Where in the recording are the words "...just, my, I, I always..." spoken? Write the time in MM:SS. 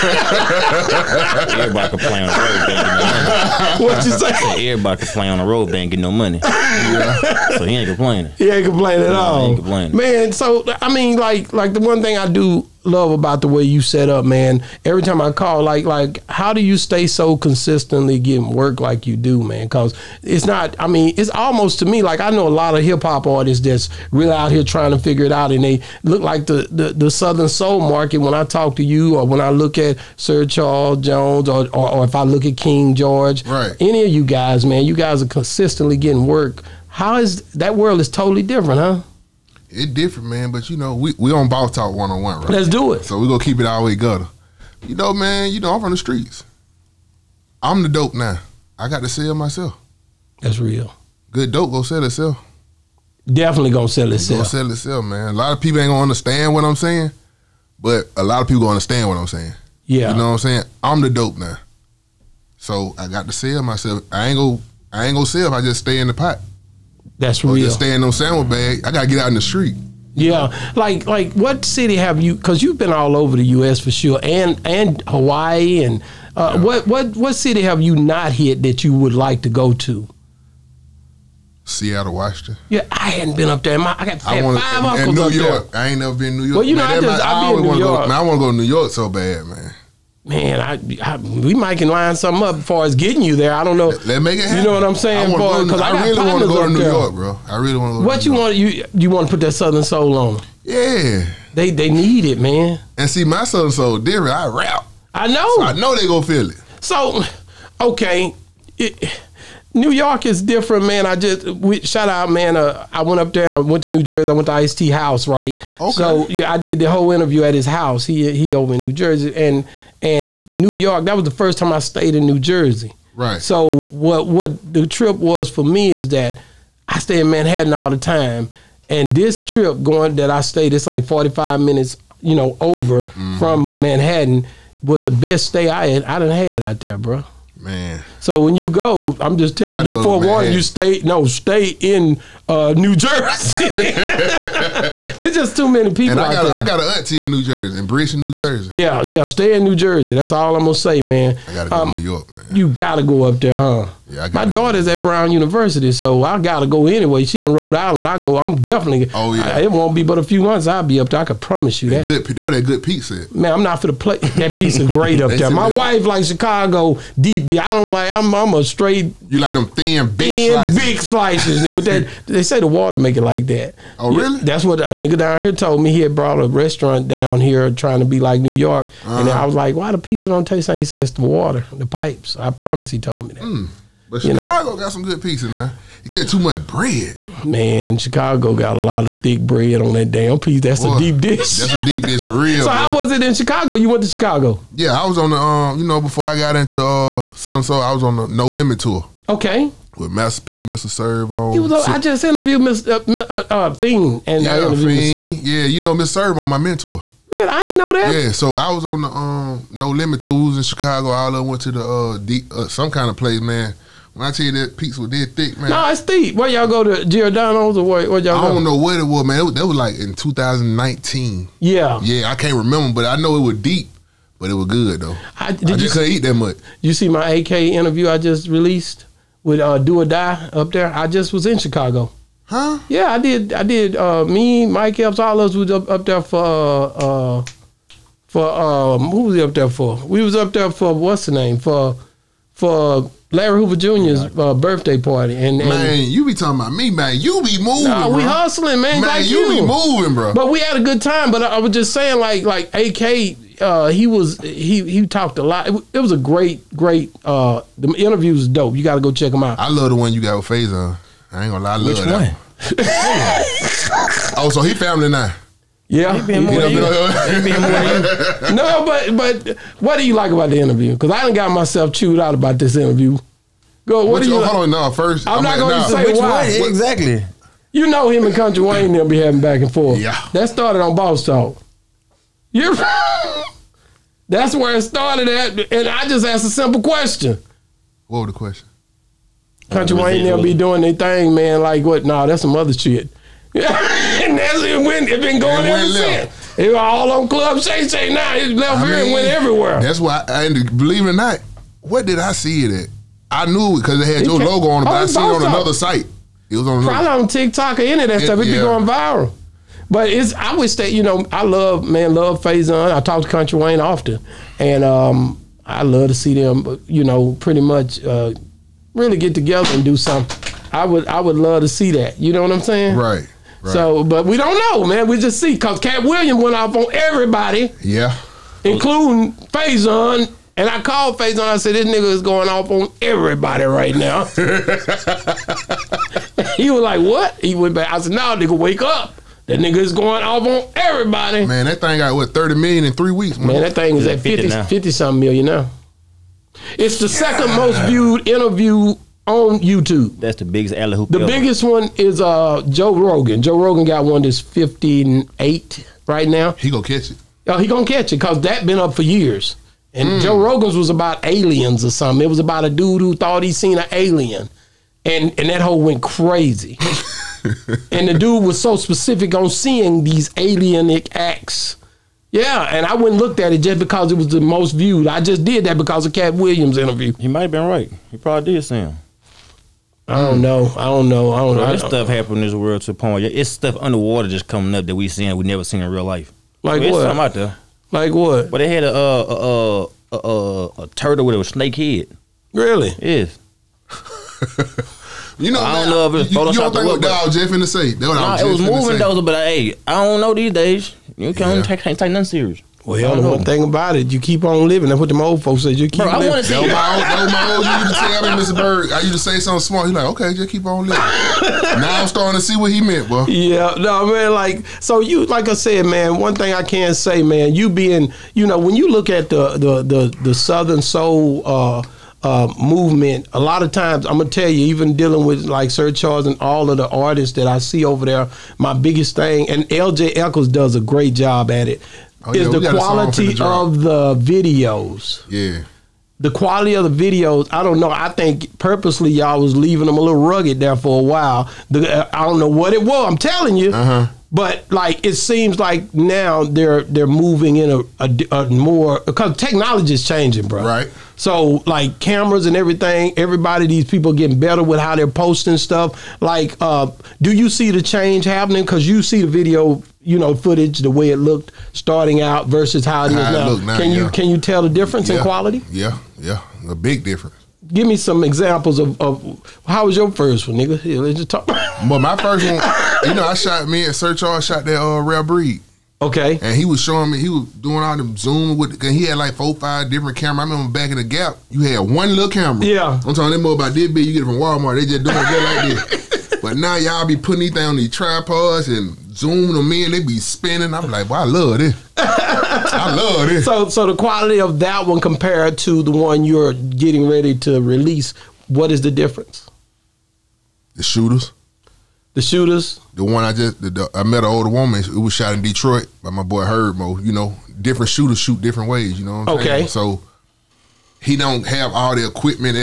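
01:27.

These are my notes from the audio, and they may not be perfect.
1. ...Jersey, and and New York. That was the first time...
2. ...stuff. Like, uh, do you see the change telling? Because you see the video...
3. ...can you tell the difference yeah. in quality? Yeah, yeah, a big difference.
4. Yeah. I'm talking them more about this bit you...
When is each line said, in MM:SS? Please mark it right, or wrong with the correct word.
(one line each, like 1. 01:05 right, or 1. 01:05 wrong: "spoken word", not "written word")
1. 01:58 right
2. 07:35 wrong: "happening", not "telling"
3. 07:44 right
4. 08:02 right.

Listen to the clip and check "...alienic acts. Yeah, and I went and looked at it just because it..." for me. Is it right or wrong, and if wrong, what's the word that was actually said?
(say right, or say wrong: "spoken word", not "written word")
right.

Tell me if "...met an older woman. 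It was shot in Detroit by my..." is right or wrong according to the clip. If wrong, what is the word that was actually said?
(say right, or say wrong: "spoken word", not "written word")
right.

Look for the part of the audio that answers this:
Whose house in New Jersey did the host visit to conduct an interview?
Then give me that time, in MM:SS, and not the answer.
01:54.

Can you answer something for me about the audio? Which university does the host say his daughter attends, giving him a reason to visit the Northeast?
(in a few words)
Brown University.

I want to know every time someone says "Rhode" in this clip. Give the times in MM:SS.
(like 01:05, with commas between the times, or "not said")
02:37.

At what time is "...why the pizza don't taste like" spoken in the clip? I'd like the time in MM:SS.
02:59.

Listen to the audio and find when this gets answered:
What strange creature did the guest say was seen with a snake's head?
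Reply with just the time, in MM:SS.
06:30.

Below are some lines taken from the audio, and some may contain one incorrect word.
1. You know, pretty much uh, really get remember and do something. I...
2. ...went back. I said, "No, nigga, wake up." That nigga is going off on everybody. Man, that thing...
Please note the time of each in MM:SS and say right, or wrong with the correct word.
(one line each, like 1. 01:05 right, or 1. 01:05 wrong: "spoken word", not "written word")
1. 05:16 wrong: "together", not "remember"
2. 05:37 right.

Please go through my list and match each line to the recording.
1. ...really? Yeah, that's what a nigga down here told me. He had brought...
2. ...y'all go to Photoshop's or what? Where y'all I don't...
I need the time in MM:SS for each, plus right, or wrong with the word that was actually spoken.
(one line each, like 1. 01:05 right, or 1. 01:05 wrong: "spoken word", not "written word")
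1. 02:54 right
2. 03:36 wrong: "Giordano", not "Photoshop".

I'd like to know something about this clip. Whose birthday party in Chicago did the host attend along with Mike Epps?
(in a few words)
Larry Hoover Jr.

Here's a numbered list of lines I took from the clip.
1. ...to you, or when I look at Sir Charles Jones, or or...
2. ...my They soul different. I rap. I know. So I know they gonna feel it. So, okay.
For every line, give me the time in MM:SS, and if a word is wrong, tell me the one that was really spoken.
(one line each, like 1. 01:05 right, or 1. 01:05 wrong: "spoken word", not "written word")
1. 00:28 right
2. 01:43 wrong: "Southern", not "They".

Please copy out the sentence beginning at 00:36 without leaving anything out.
How is that world is totally different, huh?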